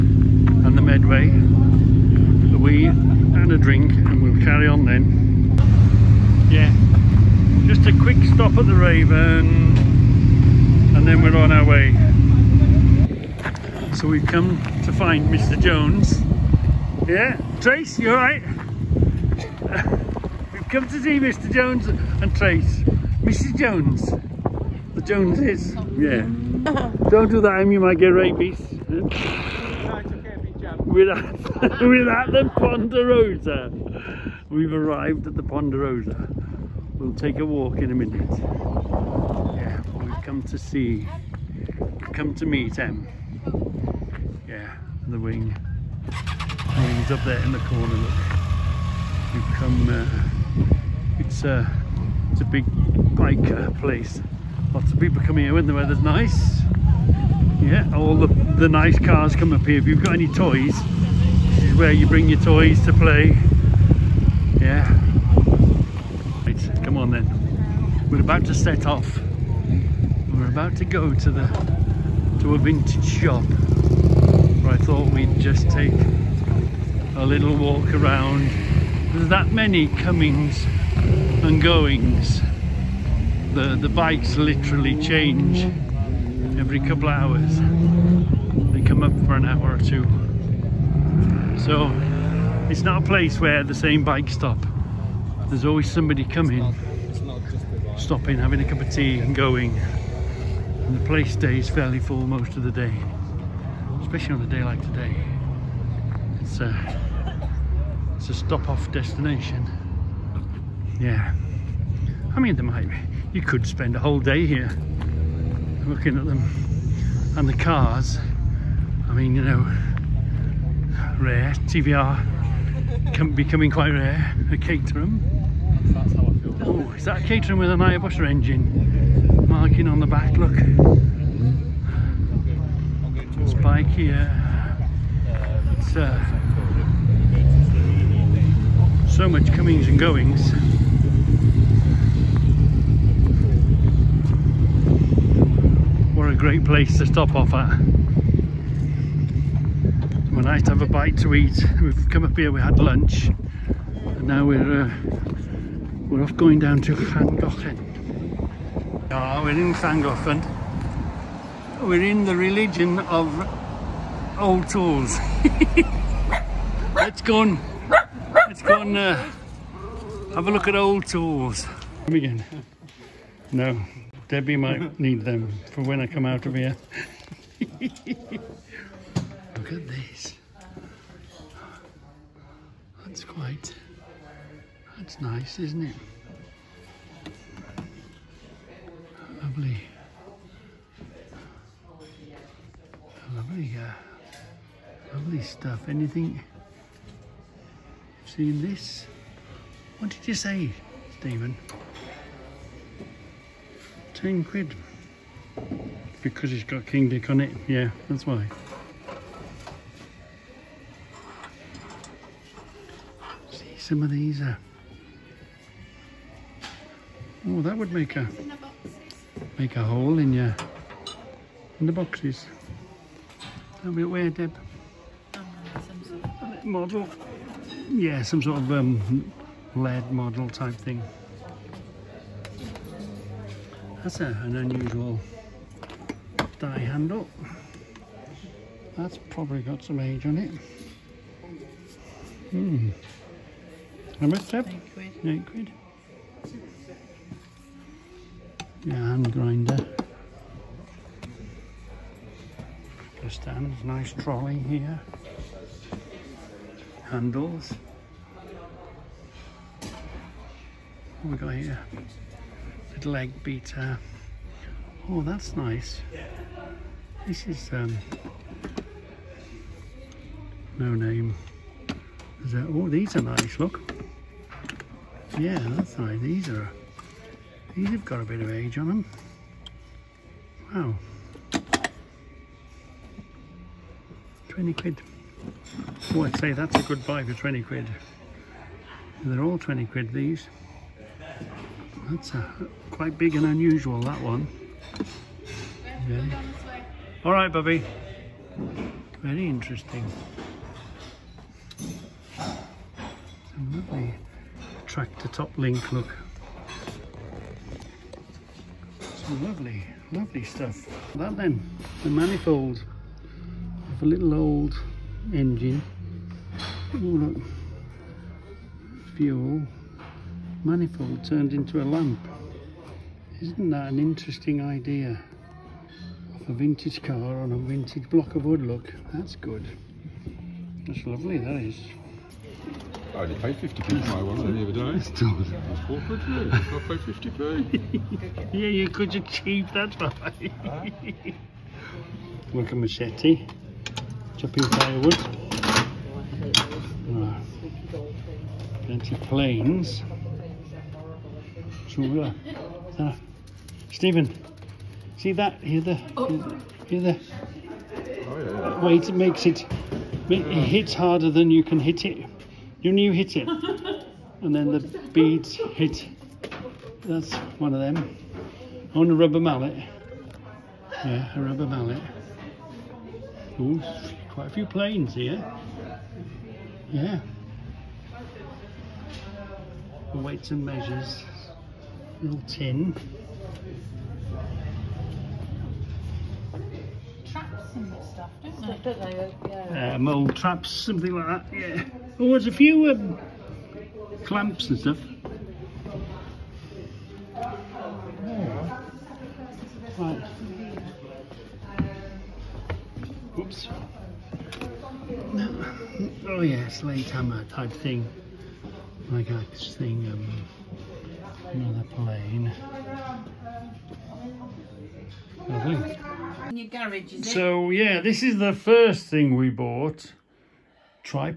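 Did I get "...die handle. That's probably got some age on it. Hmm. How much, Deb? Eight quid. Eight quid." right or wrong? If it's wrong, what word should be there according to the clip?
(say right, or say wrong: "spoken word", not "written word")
right.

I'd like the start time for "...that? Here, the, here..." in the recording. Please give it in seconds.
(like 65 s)
355 s.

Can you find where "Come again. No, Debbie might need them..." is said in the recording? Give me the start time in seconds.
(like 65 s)
172 s.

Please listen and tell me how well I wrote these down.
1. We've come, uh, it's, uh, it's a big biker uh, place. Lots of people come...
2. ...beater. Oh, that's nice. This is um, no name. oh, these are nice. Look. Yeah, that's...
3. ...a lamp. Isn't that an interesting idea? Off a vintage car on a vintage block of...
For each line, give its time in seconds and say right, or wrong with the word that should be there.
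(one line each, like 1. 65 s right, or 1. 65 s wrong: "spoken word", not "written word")
1. 49 s right
2. 263 s right
3. 321 s right.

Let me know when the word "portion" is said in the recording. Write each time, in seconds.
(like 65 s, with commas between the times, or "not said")
not said.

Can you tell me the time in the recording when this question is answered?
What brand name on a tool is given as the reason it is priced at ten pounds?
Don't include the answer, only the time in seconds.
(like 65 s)
206 s.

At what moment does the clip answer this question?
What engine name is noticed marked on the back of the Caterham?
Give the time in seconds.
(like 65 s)
127 s.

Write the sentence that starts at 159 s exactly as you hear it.
Ah, oh, we're in Llangollen we're in the religion of old tools.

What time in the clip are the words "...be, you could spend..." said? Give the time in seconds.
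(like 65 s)
112 s.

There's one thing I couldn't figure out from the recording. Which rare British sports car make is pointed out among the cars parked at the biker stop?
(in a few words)
TVR.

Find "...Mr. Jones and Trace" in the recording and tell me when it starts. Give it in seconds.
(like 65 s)
21 s.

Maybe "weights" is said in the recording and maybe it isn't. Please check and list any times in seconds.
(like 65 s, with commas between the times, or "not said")
380 s.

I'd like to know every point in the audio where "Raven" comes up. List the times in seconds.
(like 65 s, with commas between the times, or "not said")
8 s.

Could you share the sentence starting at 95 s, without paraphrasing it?
There's always somebody coming, stopping, having a cup of tea and going.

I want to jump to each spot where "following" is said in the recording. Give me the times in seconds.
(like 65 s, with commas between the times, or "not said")
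not said.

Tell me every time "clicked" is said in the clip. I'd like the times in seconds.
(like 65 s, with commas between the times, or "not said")
not said.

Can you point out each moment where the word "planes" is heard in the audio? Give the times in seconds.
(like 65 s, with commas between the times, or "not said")
349 s, 374 s, 411 s.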